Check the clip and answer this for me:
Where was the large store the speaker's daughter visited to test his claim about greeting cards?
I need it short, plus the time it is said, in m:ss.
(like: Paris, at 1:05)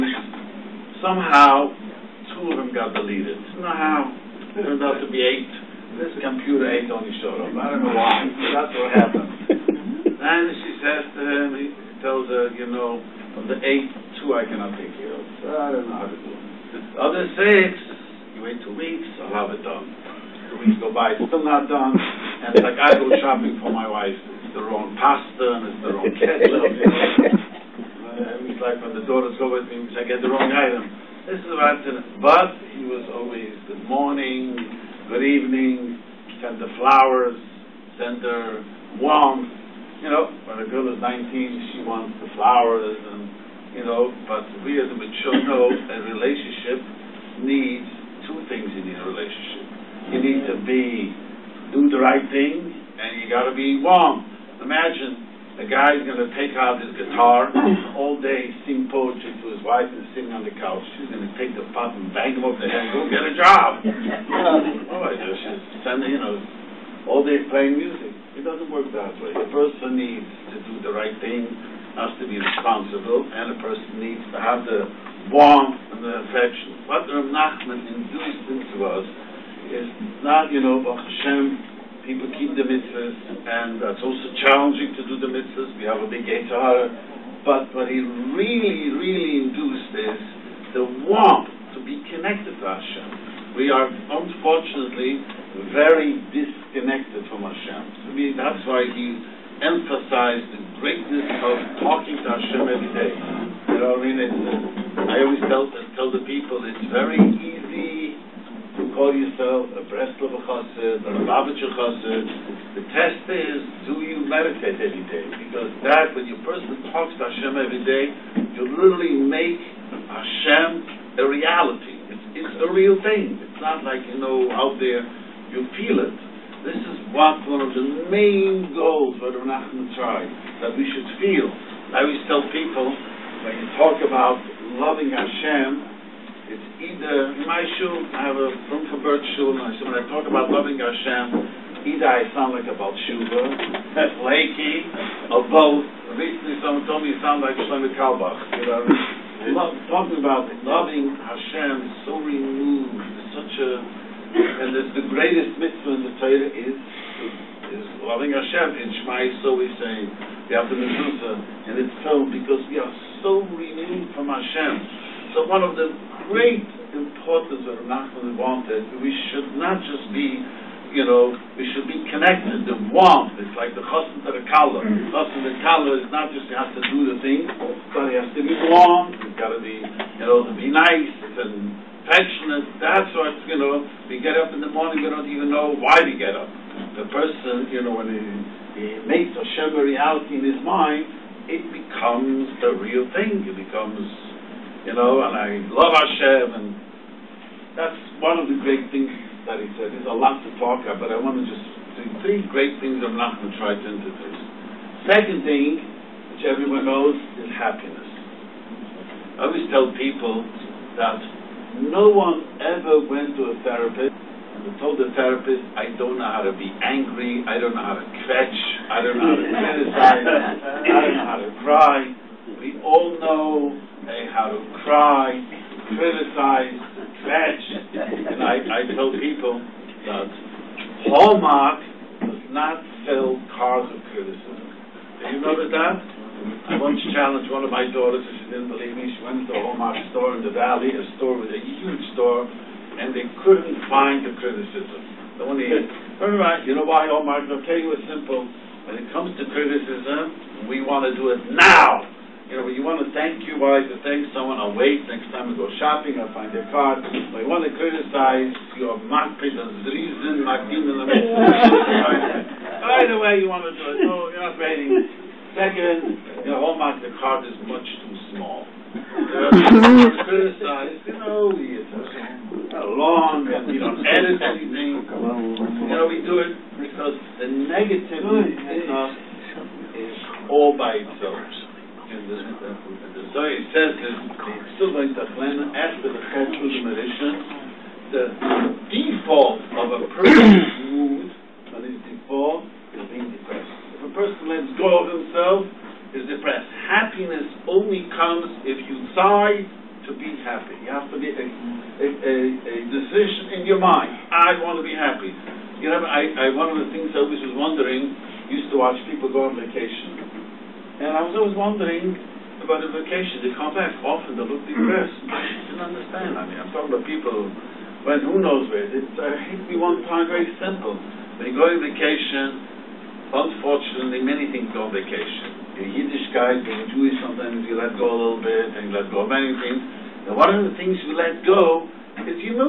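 the valley, at 4:00.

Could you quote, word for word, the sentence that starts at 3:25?
Second thing, which everyone knows, is happiness.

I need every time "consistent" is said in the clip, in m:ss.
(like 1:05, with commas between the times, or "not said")
not said.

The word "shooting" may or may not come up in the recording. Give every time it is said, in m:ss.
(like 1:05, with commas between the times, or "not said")
not said.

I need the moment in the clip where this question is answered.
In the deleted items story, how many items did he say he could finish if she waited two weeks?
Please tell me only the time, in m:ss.
0:16.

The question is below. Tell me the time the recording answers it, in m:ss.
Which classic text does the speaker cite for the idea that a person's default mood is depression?
4:42.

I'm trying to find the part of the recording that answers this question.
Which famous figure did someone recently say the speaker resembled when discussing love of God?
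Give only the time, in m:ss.
2:27.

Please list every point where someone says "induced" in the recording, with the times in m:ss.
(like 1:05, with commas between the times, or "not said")
1:17, 1:29.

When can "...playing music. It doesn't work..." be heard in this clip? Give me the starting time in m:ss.
1:07.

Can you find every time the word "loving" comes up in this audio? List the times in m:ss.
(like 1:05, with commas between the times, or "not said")
2:14, 2:20, 2:30, 2:38.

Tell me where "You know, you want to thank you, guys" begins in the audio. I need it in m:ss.
4:12.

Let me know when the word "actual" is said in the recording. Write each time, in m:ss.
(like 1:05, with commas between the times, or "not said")
not said.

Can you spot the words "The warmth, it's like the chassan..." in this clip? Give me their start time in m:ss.
2:52.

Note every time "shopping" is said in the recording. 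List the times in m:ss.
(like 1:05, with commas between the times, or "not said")
0:23, 4:15.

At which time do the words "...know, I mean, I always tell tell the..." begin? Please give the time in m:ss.
1:43.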